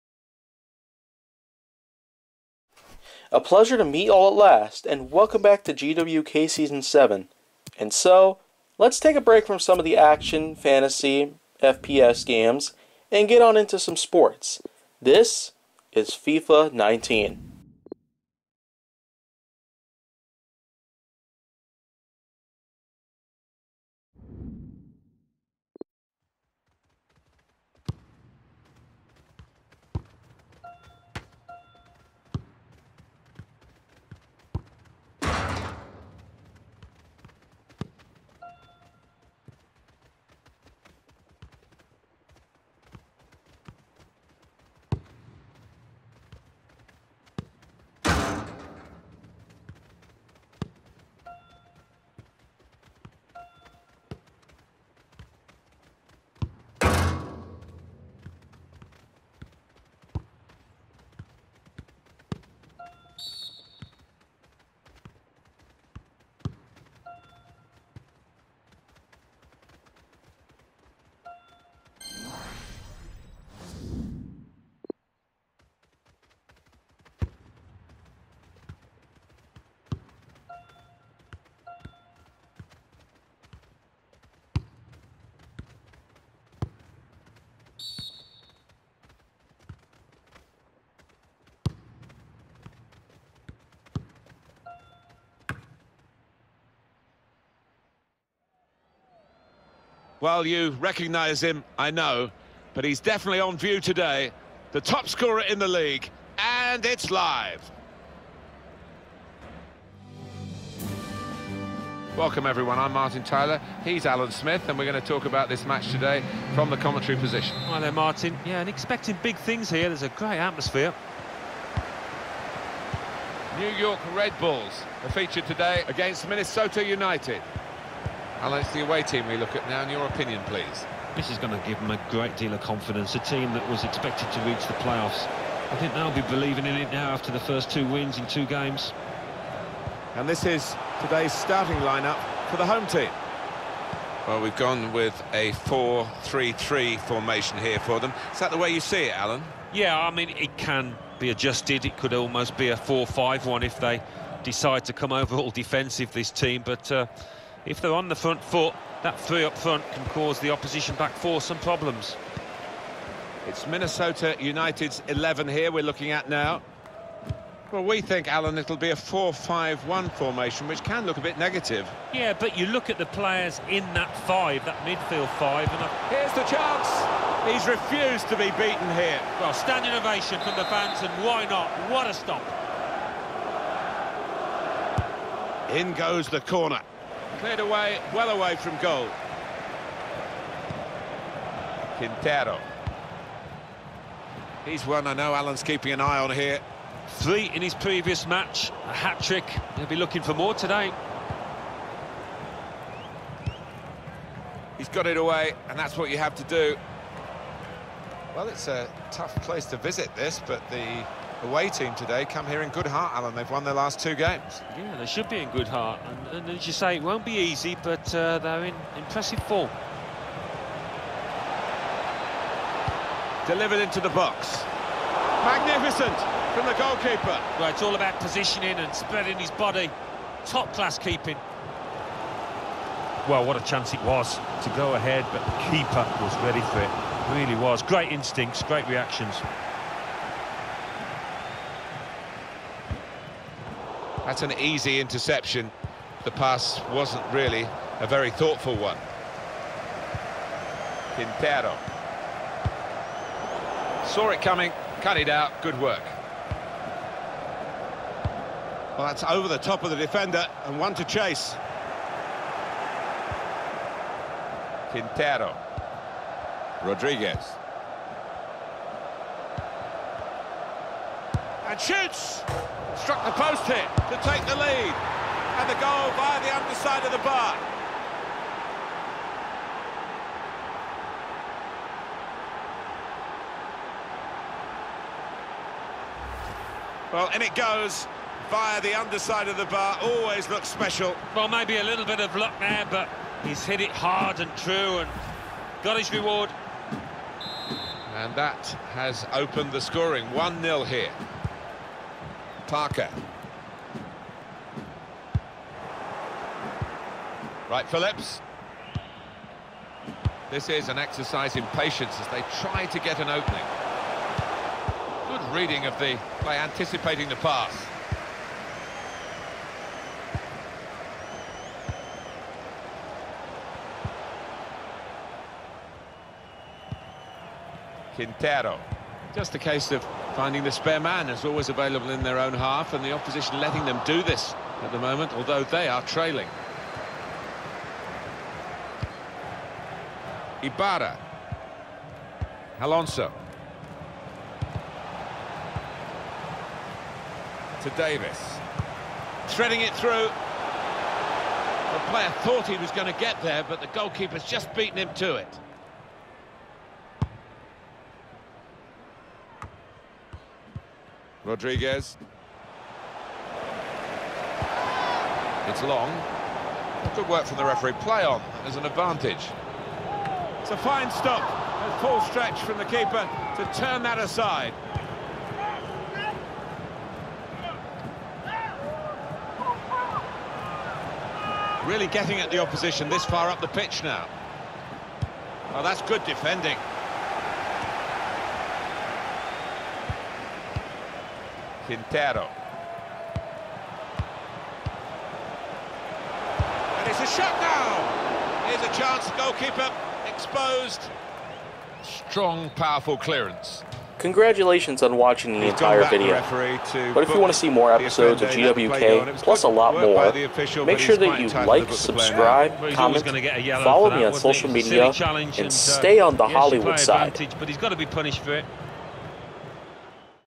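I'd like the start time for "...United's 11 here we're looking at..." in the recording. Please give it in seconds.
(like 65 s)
164 s.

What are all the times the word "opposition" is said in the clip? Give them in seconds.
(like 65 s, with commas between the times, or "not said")
160 s, 333 s, 382 s.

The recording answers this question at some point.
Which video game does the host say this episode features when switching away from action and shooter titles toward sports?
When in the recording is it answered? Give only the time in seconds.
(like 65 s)
16 s.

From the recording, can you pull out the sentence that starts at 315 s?
Good reading of the play, anticipating the pass.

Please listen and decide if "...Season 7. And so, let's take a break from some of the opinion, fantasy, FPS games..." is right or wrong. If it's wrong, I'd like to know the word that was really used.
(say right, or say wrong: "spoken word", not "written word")
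wrong: "action", not "opinion".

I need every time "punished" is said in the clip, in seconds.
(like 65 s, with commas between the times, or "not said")
418 s.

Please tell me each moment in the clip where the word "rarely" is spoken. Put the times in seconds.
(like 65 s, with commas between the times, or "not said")
not said.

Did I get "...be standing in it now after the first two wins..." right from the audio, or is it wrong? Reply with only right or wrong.
wrong.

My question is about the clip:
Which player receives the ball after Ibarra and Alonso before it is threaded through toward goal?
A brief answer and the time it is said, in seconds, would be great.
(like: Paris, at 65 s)
Davis, at 347 s.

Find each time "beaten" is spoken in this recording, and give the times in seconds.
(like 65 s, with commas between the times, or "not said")
178 s, 354 s.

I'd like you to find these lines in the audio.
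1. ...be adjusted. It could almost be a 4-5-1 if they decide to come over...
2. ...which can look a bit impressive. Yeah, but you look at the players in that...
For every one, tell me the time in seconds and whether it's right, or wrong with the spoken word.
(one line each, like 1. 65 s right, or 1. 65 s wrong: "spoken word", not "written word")
1. 151 s right
2. 170 s wrong: "negative", not "impressive".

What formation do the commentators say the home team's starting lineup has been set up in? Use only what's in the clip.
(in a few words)
4-3-3.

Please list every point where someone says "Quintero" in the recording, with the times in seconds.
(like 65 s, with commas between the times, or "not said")
191 s, 251 s, 264 s, 328 s, 391 s.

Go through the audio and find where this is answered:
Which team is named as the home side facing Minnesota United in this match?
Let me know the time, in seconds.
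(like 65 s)
123 s.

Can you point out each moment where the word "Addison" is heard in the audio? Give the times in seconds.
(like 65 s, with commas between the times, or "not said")
not said.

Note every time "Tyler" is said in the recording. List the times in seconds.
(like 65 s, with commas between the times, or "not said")
113 s.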